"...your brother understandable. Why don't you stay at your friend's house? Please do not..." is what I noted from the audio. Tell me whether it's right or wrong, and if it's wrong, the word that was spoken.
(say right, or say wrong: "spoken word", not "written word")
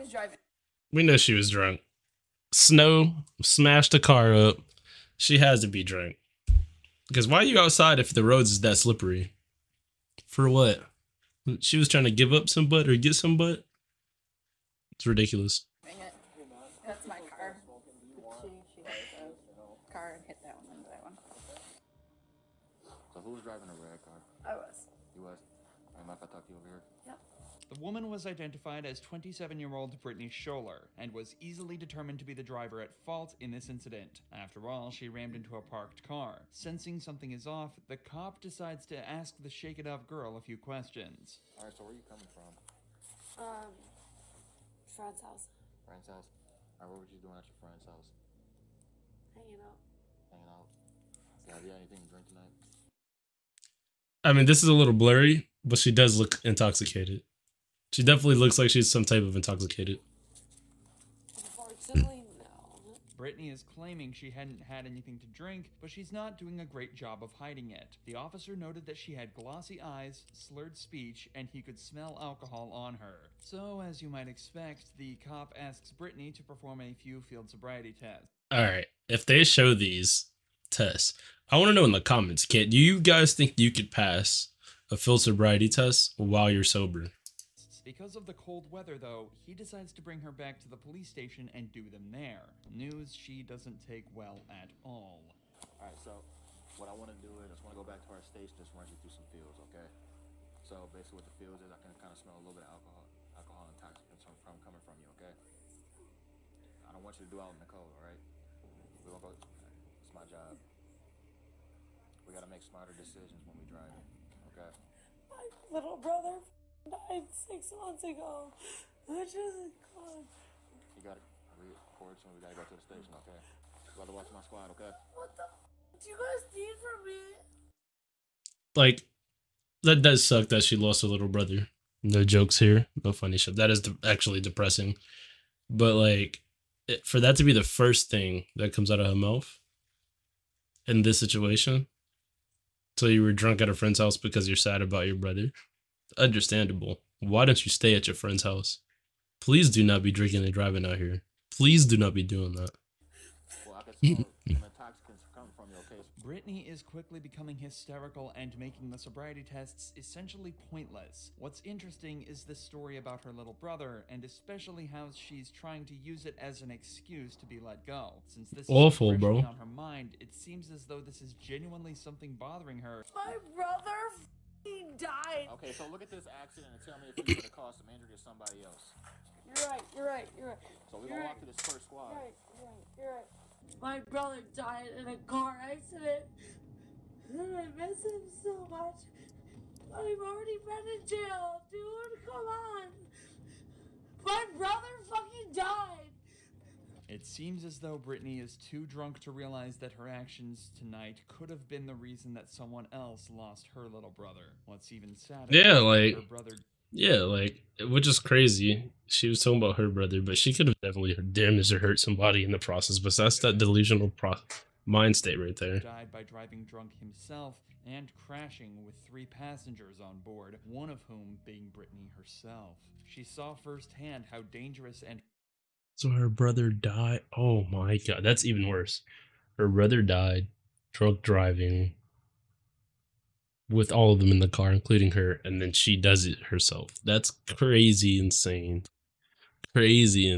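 right.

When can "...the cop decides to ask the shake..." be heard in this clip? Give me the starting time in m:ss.
0:37.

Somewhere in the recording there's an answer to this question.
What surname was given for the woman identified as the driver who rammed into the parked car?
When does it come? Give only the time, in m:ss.
0:30.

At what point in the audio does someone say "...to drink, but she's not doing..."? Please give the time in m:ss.
1:05.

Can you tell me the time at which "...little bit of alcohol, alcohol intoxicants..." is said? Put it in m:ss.
1:42.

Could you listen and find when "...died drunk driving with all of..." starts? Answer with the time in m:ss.
3:50.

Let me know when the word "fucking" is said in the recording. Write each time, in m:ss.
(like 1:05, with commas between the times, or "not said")
3:15.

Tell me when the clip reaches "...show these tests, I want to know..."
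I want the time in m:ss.
1:19.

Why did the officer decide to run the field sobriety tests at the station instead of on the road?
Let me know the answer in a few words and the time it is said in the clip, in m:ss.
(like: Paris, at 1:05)
The cold weather, at 1:28.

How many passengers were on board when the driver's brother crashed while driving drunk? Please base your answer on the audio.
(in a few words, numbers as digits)
3.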